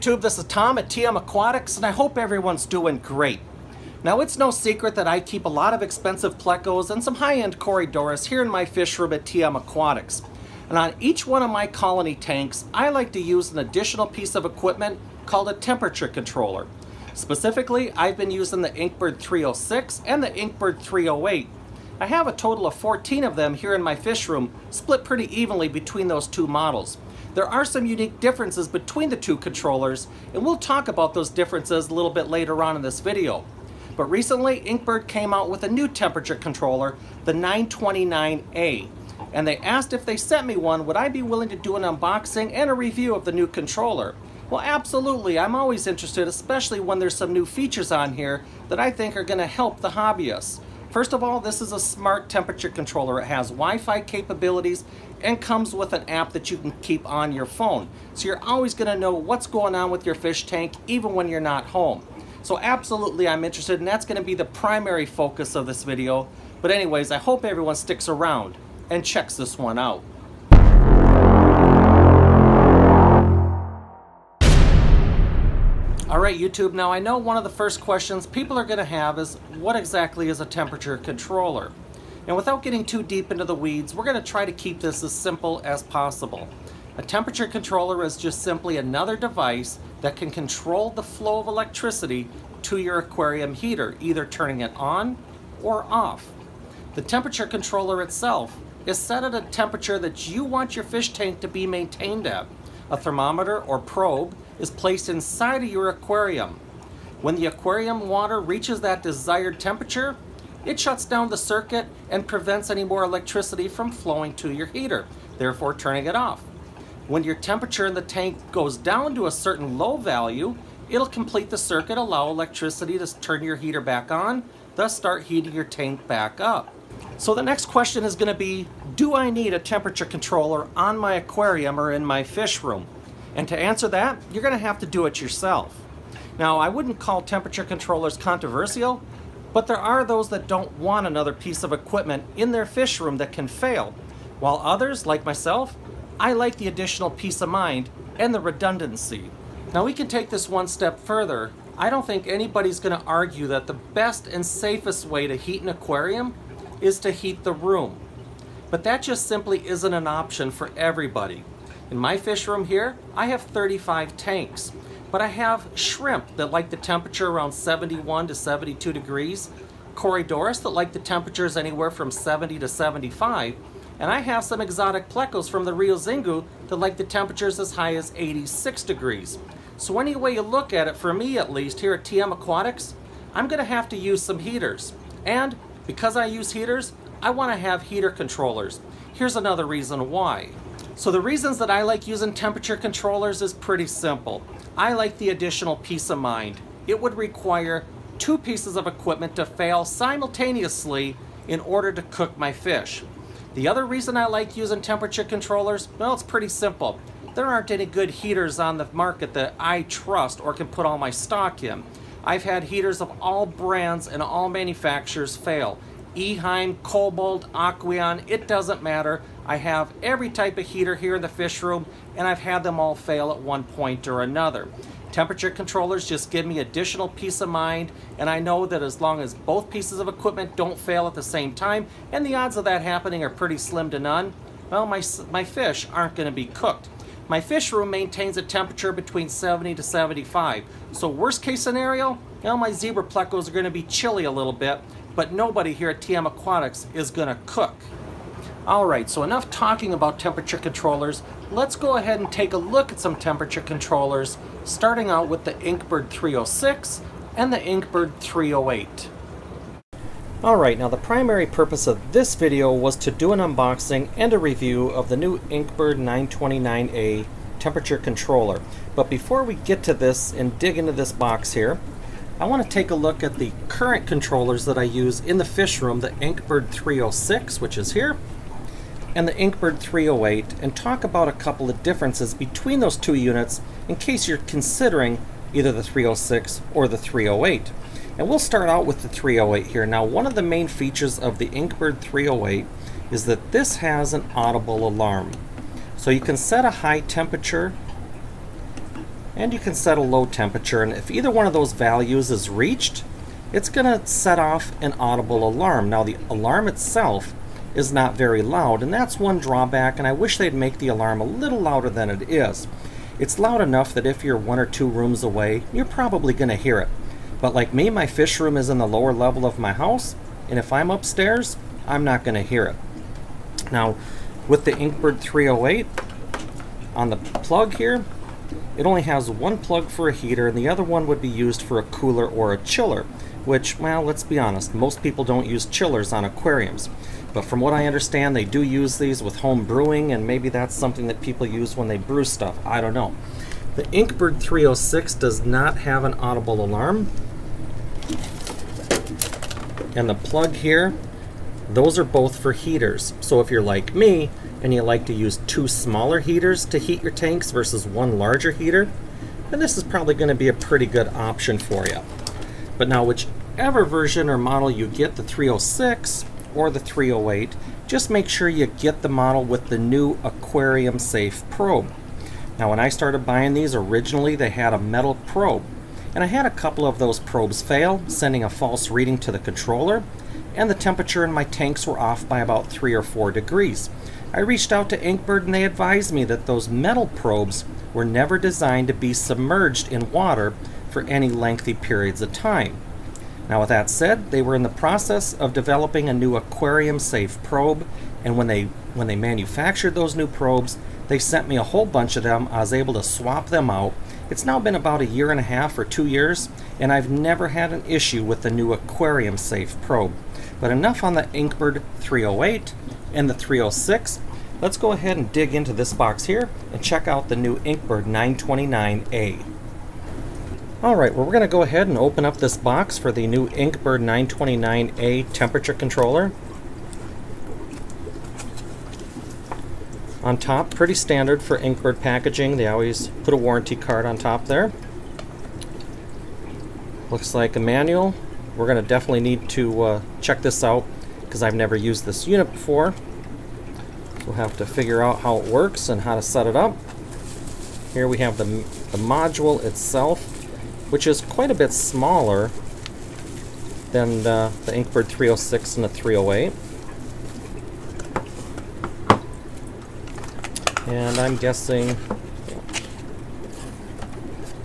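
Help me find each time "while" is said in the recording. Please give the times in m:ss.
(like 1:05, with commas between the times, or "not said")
2:24.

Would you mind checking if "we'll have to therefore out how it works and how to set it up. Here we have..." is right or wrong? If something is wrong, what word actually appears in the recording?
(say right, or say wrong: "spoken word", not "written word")
wrong: "figure", not "therefore".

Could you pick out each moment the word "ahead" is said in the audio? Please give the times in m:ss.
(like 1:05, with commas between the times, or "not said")
4:11, 6:54, 7:01.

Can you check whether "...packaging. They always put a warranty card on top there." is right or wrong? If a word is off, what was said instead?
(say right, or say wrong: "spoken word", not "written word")
right.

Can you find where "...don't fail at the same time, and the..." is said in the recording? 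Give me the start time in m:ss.
3:50.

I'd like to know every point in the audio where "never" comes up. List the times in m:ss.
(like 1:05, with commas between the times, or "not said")
6:28, 6:47, 7:21.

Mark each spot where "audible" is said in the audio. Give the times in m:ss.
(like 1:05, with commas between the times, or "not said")
4:54, 5:04, 5:46.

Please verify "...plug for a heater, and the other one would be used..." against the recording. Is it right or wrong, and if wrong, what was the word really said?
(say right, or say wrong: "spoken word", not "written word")
right.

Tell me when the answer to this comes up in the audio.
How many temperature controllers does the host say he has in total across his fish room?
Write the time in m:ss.
0:22.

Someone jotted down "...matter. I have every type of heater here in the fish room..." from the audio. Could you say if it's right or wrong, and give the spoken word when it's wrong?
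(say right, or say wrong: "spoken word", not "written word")
right.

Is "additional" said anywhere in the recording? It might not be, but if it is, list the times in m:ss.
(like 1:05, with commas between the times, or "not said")
0:13, 2:26, 3:15, 3:46.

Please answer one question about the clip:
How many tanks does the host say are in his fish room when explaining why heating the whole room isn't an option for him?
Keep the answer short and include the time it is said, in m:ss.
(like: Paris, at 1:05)
35, at 2:43.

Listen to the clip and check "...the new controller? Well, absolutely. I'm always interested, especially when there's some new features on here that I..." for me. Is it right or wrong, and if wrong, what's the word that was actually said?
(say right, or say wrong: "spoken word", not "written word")
right.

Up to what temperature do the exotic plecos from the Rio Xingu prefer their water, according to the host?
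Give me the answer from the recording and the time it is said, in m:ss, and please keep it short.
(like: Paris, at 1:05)
86 degrees, at 2:58.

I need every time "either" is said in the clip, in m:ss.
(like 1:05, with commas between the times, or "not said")
1:33, 4:45, 5:01.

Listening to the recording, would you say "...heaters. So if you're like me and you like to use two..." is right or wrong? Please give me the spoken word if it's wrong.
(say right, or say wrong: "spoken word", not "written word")
right.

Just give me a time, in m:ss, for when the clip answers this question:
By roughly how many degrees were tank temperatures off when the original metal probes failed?
6:22.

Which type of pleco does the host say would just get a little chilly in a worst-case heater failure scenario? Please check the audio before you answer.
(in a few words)
zebra plecos.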